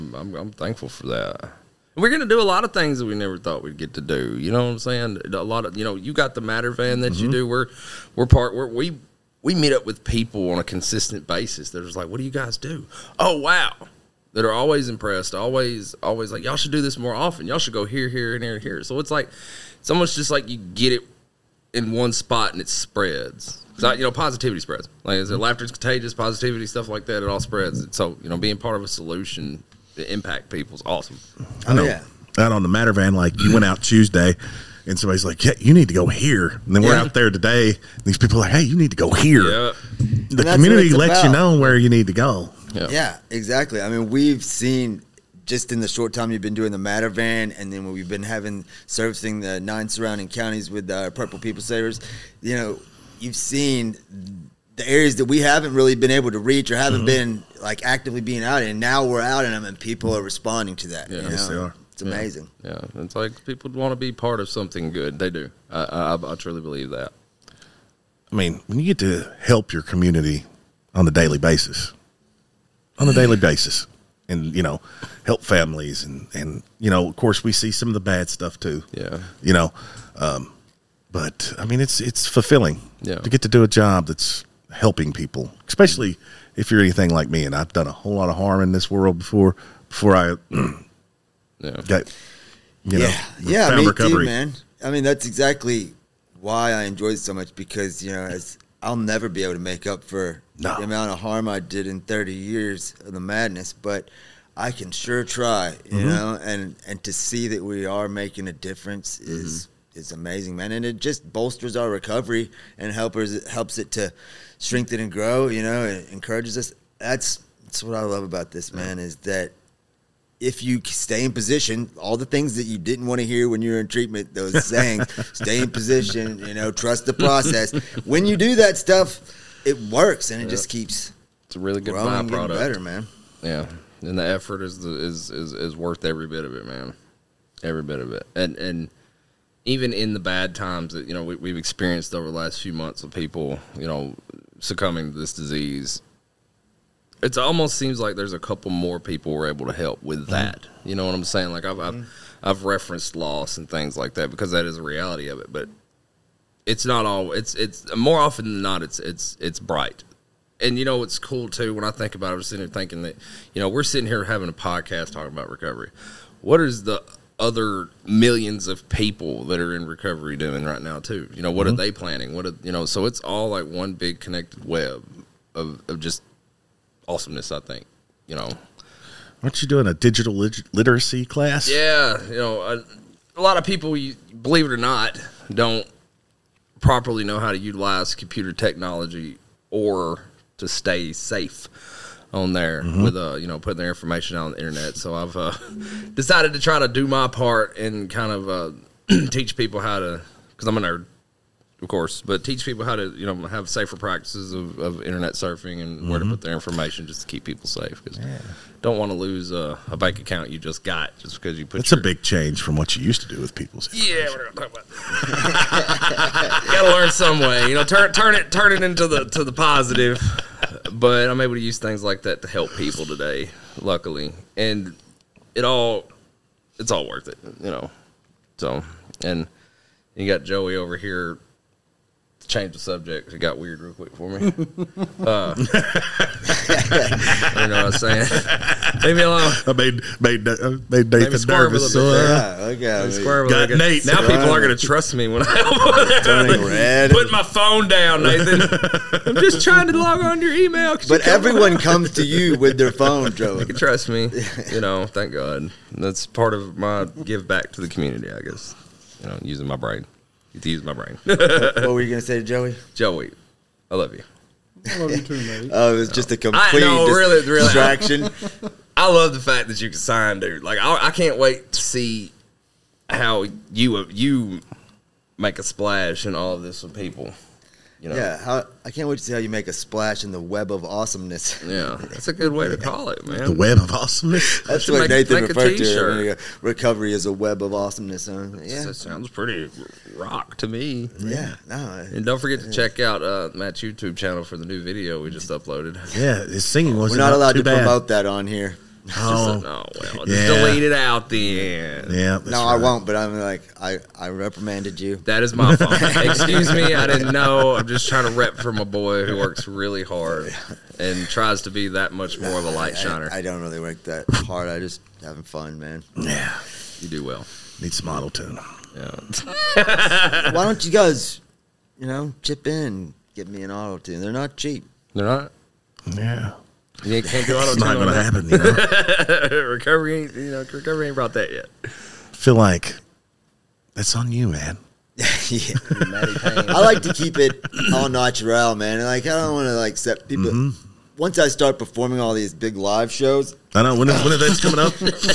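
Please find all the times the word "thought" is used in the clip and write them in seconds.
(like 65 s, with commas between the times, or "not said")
3 s.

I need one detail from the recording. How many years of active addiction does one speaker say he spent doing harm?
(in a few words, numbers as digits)
30.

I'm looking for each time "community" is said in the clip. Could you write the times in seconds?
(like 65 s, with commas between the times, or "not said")
40 s, 69 s, 257 s.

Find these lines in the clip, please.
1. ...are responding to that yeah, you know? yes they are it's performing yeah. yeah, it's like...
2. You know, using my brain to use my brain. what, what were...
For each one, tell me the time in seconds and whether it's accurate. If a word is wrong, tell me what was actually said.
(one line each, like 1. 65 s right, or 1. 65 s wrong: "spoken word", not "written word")
1. 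60 s wrong: "amazing", not "performing"
2. 259 s right.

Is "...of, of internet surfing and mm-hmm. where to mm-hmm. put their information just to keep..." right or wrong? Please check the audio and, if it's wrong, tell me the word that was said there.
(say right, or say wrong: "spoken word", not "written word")
right.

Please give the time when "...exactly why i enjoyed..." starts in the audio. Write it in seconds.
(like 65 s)
95 s.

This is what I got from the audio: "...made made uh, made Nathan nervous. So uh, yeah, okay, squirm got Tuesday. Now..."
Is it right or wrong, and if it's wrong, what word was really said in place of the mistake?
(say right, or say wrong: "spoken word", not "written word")
wrong: "Nate", not "Tuesday".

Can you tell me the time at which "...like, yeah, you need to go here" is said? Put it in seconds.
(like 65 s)
35 s.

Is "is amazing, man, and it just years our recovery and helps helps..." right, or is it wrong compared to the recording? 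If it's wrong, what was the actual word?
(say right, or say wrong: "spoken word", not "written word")
wrong: "bolsters", not "years".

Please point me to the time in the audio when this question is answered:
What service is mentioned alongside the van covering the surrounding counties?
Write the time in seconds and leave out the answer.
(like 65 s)
51 s.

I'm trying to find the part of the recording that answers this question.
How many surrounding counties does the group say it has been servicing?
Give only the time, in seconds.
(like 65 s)
49 s.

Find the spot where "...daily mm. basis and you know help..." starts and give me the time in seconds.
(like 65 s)
73 s.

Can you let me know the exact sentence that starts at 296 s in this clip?
Yeah, his singing was We're not allowed to bad.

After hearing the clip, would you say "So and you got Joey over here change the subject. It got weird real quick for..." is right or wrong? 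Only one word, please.
right.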